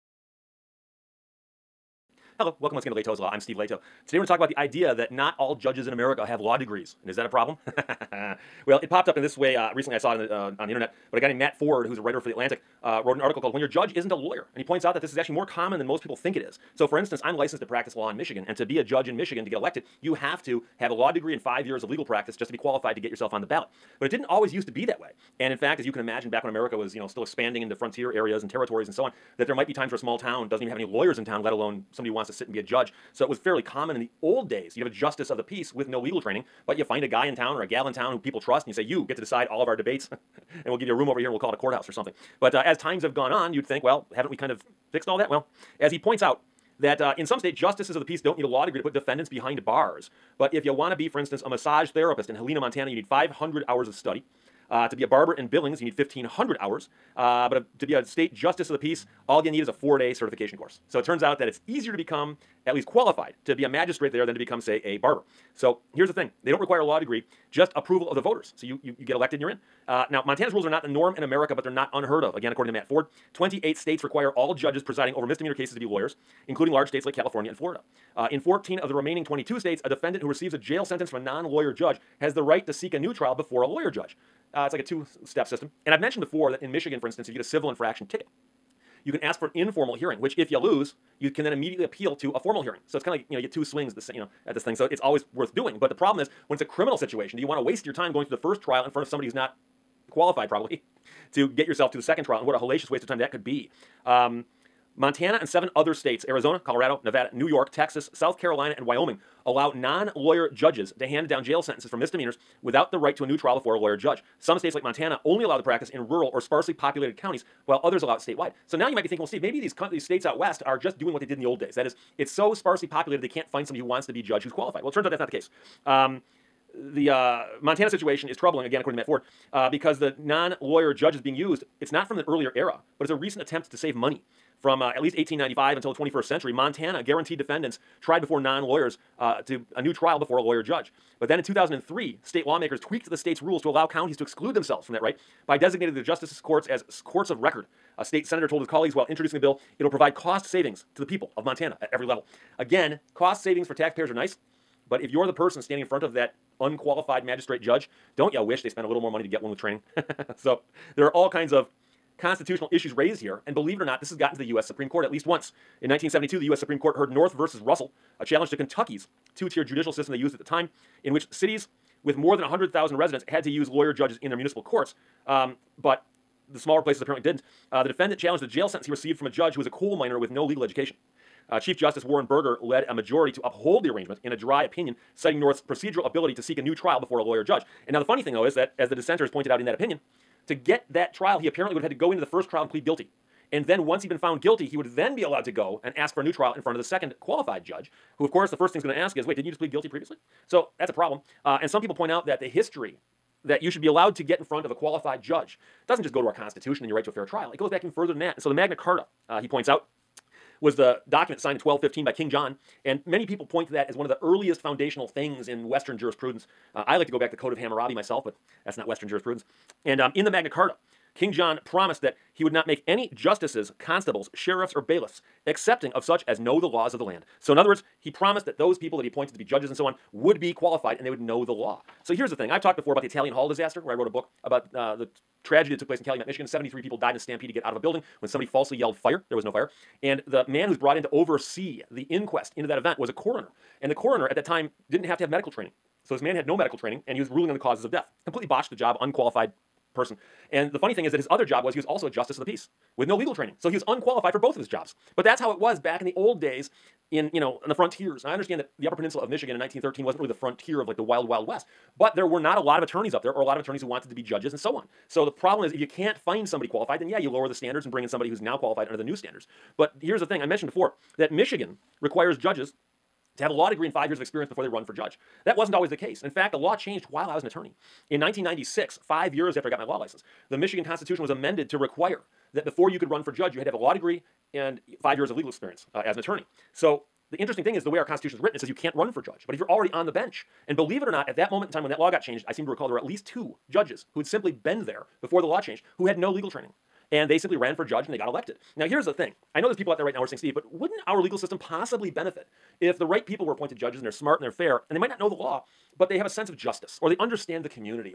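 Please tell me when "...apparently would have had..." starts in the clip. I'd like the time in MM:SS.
03:11.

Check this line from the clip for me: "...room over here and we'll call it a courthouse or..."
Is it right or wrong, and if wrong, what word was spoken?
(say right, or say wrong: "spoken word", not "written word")
right.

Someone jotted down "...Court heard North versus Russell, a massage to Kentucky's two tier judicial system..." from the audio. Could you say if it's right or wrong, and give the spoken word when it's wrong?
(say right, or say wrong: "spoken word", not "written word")
wrong: "challenge", not "massage".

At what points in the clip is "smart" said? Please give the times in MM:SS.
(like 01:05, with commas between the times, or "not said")
05:04.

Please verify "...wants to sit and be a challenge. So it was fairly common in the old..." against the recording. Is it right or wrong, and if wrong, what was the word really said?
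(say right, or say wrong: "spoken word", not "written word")
wrong: "judge", not "challenge".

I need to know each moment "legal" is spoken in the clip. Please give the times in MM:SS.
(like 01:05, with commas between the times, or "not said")
00:21, 00:35, 03:00, 04:13, 04:45, 04:56, 05:01.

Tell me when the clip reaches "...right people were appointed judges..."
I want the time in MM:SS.
05:03.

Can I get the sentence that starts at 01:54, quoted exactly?
Some states, like Montana, only allow the practice in rural or sparsely populated counties while others allow it statewide.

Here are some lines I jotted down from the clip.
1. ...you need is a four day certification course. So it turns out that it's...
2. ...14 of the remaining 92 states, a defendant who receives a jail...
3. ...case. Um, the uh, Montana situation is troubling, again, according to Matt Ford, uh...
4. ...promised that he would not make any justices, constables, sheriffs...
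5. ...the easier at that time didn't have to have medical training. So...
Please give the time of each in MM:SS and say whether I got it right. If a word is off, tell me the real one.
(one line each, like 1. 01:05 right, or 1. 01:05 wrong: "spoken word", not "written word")
1. 00:59 right
2. 01:18 wrong: "22", not "92"
3. 02:05 right
4. 03:41 right
5. 04:03 wrong: "coroner", not "easier".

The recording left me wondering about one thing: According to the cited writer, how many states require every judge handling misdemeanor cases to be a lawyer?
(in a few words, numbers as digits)
28.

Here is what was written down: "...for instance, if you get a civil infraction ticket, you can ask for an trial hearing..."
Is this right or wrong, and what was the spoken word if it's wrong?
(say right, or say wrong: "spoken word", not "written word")
wrong: "informal", not "trial".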